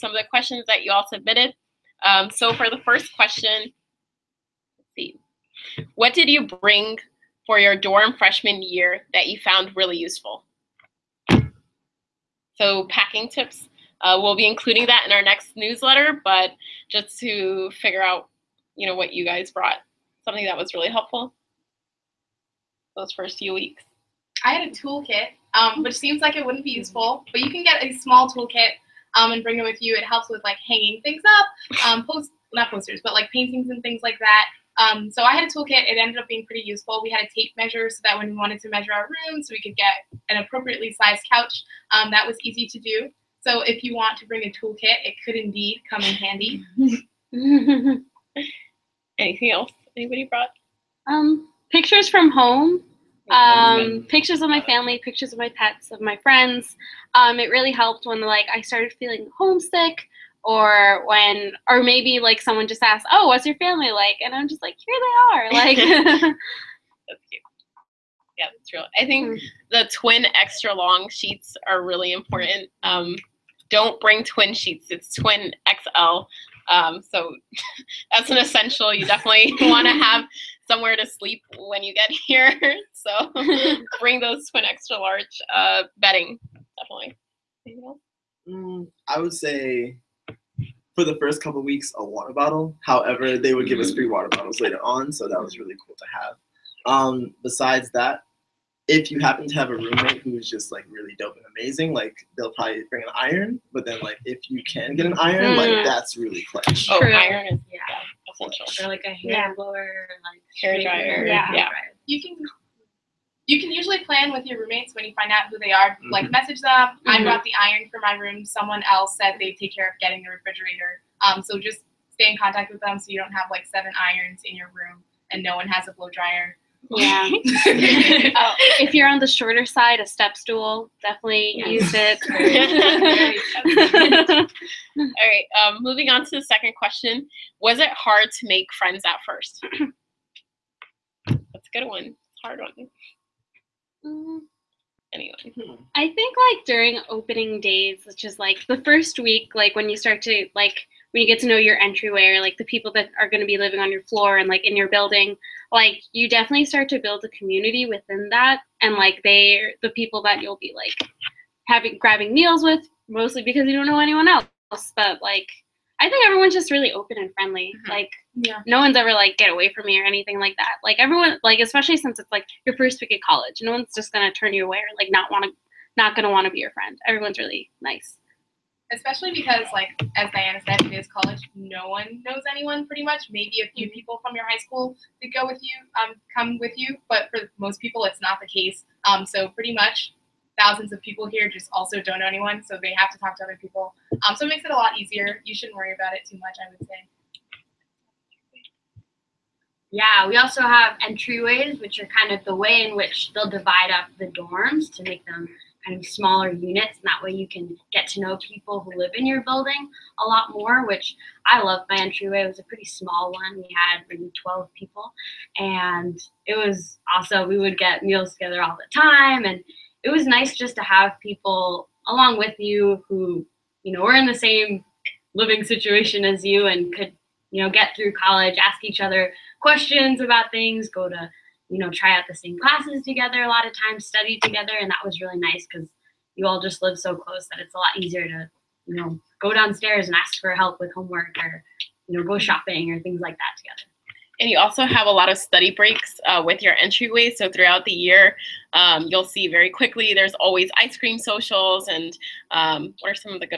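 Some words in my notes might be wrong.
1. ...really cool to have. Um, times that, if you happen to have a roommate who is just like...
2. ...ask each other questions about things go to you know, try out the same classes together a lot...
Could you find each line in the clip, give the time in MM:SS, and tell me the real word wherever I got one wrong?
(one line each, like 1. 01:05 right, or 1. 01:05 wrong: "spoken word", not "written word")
1. 01:35 wrong: "besides", not "times"
2. 03:48 right.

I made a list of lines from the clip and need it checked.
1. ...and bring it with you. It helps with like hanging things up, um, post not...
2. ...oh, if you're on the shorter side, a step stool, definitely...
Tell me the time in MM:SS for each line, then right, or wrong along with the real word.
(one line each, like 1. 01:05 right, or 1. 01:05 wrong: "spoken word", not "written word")
1. 00:29 right
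2. 02:07 right.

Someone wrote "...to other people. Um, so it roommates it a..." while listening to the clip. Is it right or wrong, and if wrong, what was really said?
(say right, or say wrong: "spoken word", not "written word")
wrong: "makes", not "roommates".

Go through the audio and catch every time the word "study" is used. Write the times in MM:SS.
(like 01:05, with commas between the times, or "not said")
03:54, 04:05.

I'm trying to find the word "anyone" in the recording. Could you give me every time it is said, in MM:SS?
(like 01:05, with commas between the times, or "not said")
02:43, 03:02, 03:12.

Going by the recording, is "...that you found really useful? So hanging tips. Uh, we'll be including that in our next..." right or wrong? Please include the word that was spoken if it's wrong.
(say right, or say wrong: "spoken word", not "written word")
wrong: "packing", not "hanging".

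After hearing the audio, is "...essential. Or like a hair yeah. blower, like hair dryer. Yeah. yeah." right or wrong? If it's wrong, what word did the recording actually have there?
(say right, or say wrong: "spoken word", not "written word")
right.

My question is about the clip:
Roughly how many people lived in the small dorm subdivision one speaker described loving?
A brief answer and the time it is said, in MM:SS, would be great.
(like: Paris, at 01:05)
12, at 03:34.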